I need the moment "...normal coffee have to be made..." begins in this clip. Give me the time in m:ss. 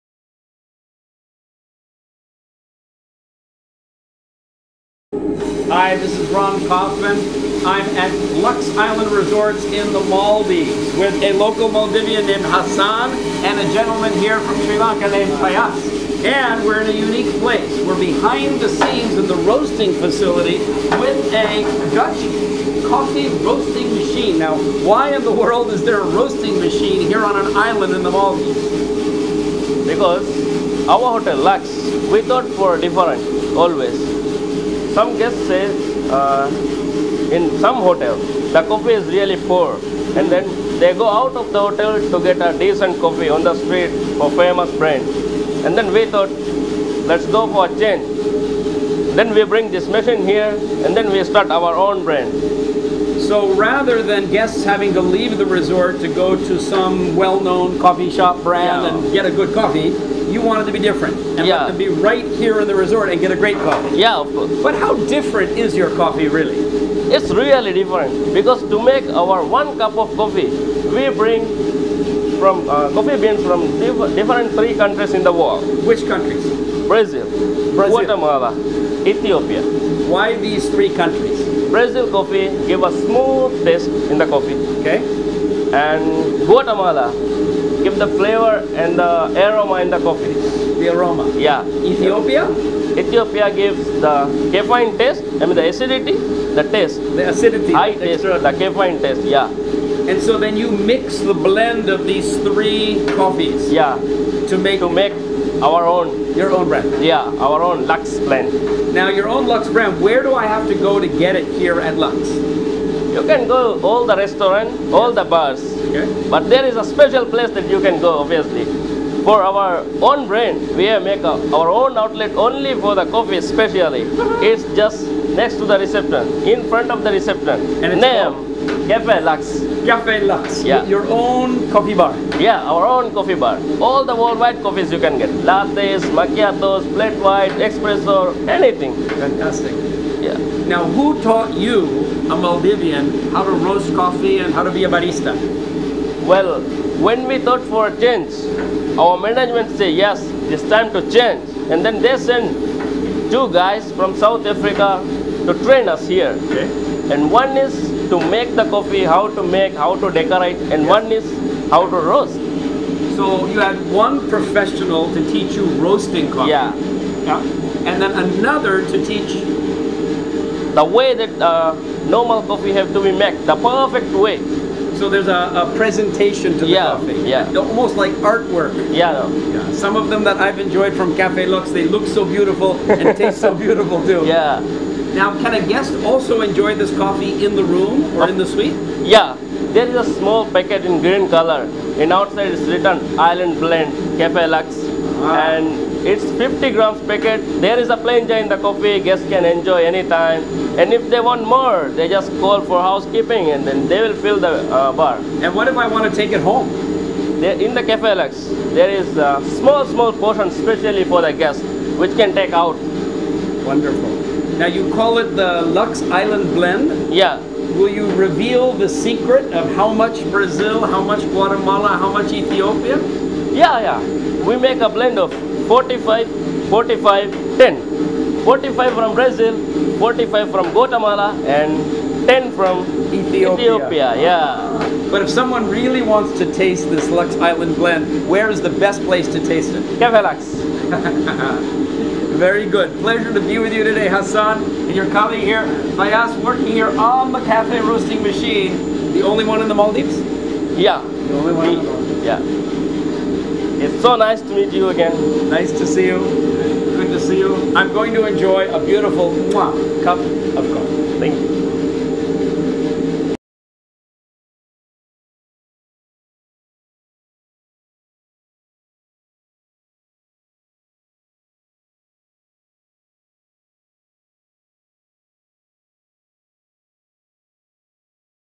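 2:52.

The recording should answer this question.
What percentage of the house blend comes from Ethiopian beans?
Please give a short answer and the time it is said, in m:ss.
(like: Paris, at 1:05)
10, at 3:52.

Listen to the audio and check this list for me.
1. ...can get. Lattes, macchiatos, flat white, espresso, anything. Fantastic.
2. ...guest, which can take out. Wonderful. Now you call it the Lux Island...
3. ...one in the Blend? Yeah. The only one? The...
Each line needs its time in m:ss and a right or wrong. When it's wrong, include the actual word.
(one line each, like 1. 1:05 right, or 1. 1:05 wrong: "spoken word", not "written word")
1. 2:14 right
2. 3:31 right
3. 4:09 wrong: "Maldives", not "Blend".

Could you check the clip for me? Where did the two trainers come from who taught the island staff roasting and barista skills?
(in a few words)
South Africa.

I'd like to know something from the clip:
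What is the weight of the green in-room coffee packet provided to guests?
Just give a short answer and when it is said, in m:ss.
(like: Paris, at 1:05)
50 grams, at 3:16.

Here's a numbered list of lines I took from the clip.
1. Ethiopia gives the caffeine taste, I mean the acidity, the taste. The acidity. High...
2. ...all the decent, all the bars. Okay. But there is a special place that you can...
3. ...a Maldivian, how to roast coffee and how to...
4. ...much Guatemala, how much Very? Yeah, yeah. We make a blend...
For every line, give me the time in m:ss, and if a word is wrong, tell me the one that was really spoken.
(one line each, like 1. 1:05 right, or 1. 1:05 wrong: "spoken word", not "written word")
1. 1:32 right
2. 1:53 wrong: "restaurant", not "decent"
3. 2:22 right
4. 3:41 wrong: "Ethiopia", not "Very".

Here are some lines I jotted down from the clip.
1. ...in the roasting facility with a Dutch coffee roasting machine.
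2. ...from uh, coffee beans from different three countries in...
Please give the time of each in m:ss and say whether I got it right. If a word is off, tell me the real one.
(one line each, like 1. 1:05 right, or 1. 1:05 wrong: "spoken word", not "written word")
1. 0:19 right
2. 1:12 right.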